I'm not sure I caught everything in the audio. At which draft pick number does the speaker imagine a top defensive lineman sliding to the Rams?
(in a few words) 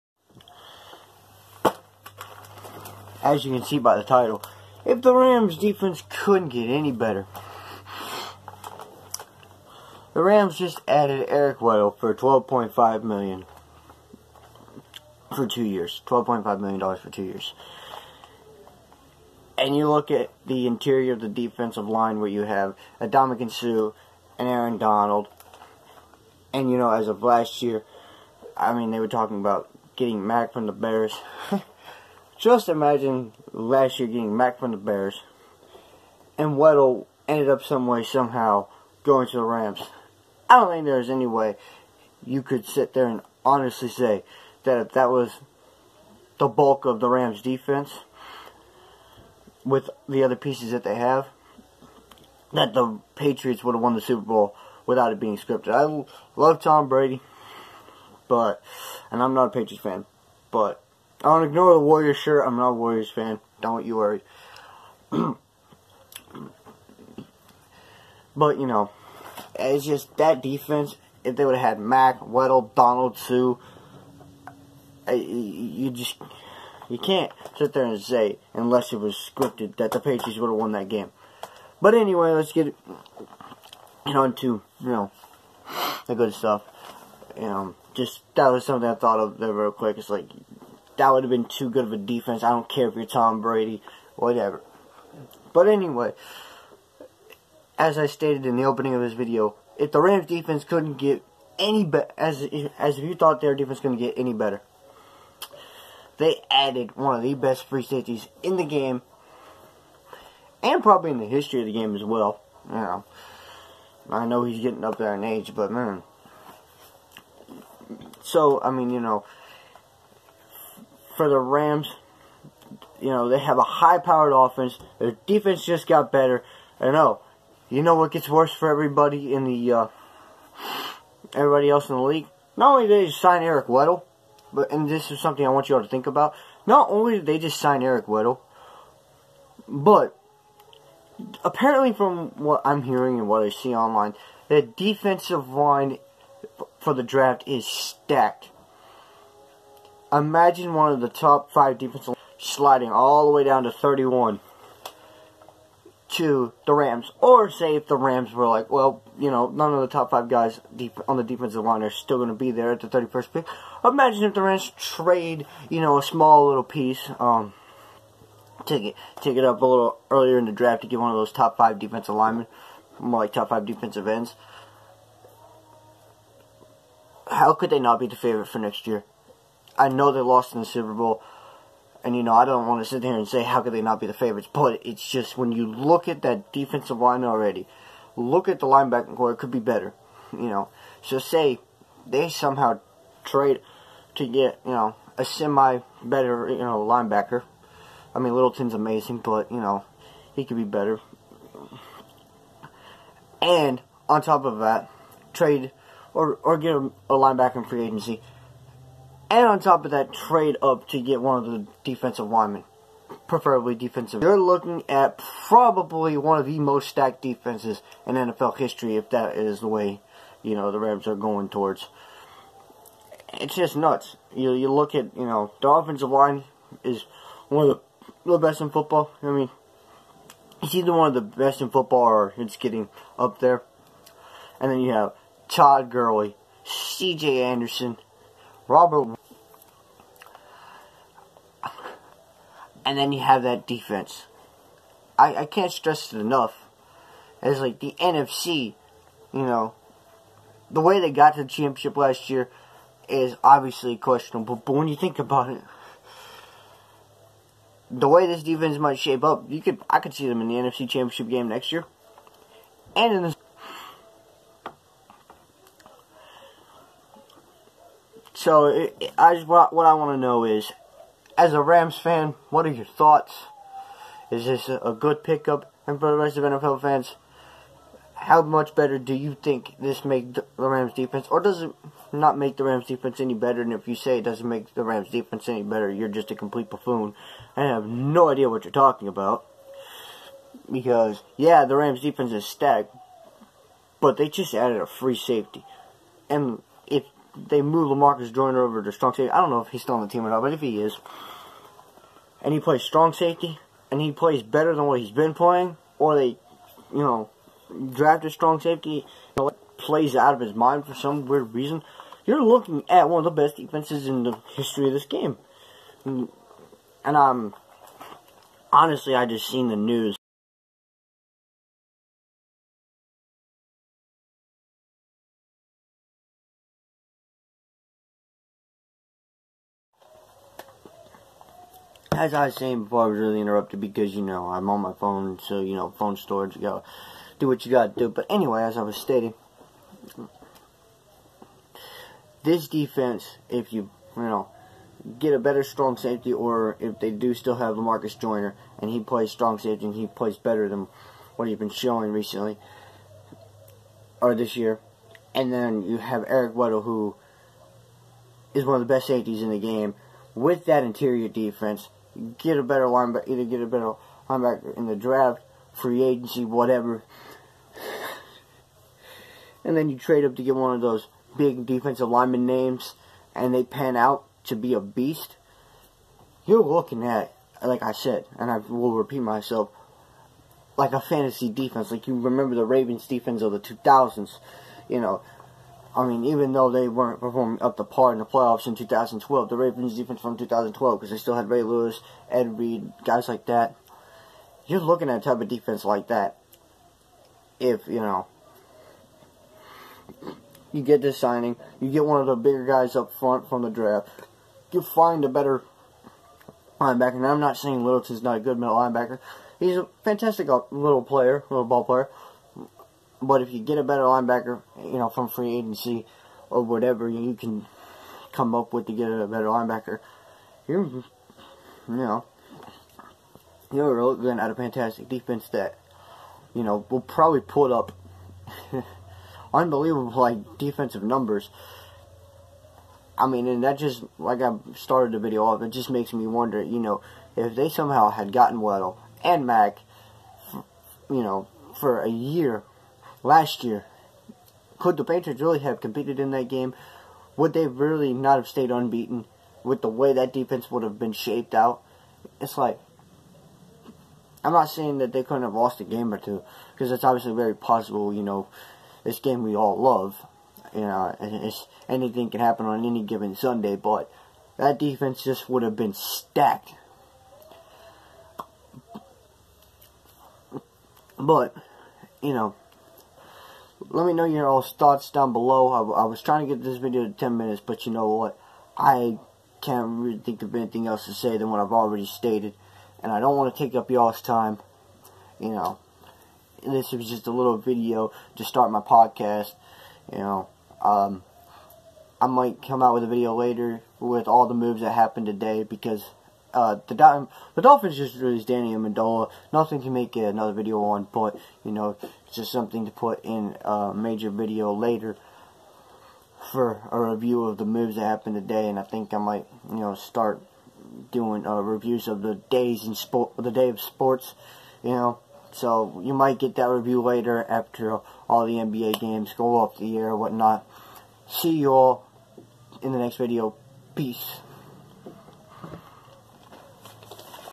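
31.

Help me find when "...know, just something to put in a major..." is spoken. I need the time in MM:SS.
08:21.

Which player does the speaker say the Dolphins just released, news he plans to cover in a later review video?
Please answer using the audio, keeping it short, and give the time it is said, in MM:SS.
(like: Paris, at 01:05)
Danny Amendola, at 08:18.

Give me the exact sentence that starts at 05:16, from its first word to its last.
And I'm um, honestly, I just seen the news.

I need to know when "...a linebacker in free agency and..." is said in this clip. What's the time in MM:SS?
03:27.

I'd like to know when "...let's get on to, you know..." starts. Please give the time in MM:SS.
01:22.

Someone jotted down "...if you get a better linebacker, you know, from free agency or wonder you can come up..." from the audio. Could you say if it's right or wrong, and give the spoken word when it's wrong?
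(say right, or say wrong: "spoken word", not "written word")
wrong: "whatever", not "wonder".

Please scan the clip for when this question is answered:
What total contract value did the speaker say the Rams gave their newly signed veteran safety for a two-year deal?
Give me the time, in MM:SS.
00:12.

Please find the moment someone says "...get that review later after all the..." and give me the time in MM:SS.
08:36.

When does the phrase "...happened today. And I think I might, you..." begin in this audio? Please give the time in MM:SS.
08:28.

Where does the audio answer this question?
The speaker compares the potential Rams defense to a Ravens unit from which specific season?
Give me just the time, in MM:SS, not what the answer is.
06:29.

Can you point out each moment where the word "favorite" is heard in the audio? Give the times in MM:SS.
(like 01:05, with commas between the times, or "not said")
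02:58, 03:04.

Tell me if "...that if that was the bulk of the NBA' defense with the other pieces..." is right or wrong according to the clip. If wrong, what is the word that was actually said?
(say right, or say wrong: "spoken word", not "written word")
wrong: "Rams", not "NBA".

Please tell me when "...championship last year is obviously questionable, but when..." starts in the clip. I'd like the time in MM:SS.
04:11.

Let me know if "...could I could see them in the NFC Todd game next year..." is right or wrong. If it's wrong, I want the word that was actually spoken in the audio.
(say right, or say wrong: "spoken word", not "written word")
wrong: "Championship", not "Todd".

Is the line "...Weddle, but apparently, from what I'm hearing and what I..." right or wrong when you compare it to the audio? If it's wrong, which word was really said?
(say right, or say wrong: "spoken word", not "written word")
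right.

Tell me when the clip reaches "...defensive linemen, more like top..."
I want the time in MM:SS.
02:51.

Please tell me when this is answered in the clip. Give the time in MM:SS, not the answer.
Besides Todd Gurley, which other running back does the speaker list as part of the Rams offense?
03:56.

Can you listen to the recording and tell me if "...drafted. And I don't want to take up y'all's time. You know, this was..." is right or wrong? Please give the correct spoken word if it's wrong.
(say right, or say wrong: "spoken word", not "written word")
wrong: "stated", not "drafted".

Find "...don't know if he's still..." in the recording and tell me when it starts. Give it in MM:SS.
04:59.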